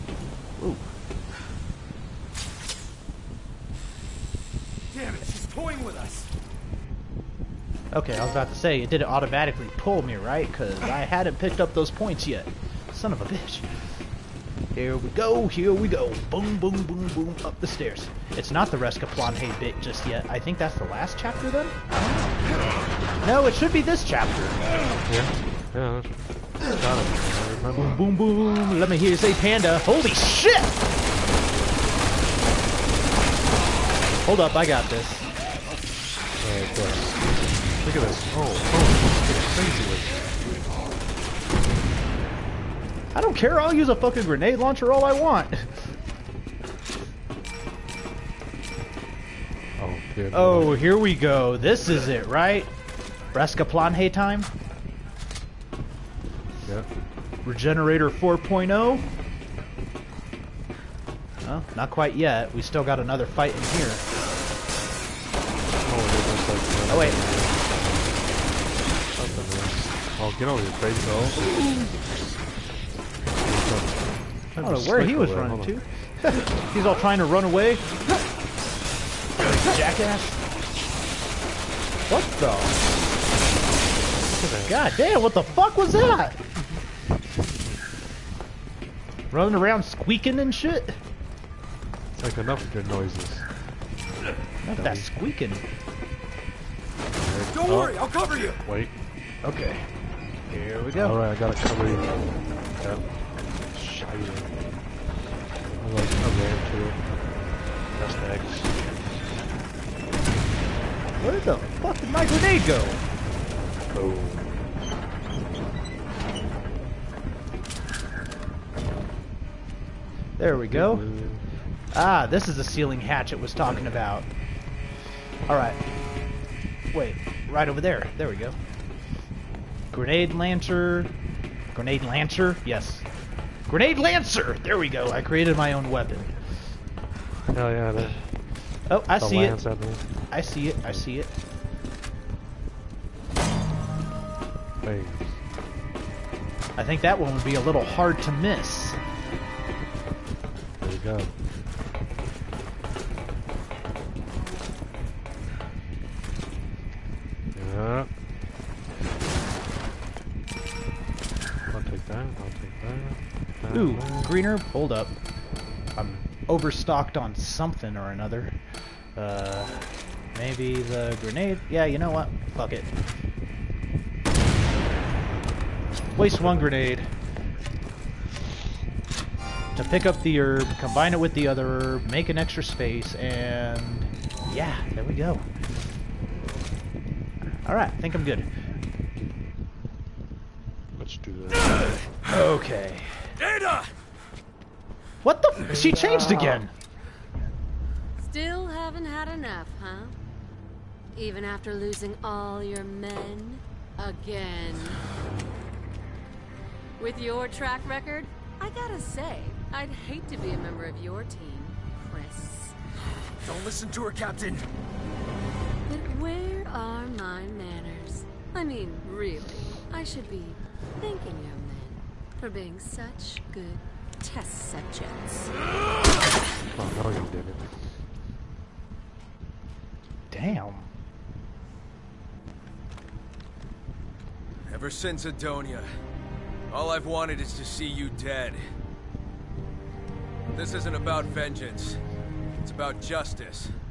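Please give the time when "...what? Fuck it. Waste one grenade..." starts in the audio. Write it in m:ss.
2:52.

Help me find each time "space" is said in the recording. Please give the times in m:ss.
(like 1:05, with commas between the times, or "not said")
3:02.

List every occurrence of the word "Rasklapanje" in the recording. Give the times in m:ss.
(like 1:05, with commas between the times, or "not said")
0:18, 0:53.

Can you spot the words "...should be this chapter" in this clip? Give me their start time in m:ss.
0:23.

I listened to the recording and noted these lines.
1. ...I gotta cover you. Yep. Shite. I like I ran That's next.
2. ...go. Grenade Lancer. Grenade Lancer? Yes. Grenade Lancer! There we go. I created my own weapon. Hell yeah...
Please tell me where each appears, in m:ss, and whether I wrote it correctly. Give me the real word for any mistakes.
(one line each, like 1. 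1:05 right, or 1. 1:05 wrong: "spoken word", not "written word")
1. 1:41 right
2. 2:08 right.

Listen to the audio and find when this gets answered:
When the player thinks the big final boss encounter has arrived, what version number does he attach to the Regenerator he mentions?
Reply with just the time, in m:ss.
0:57.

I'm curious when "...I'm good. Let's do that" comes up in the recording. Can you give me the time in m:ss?
3:08.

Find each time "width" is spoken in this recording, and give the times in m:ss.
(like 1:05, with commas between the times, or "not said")
not said.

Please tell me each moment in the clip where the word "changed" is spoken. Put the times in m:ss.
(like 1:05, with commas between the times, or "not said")
3:15.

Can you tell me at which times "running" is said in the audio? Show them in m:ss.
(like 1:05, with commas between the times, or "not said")
1:15, 1:29.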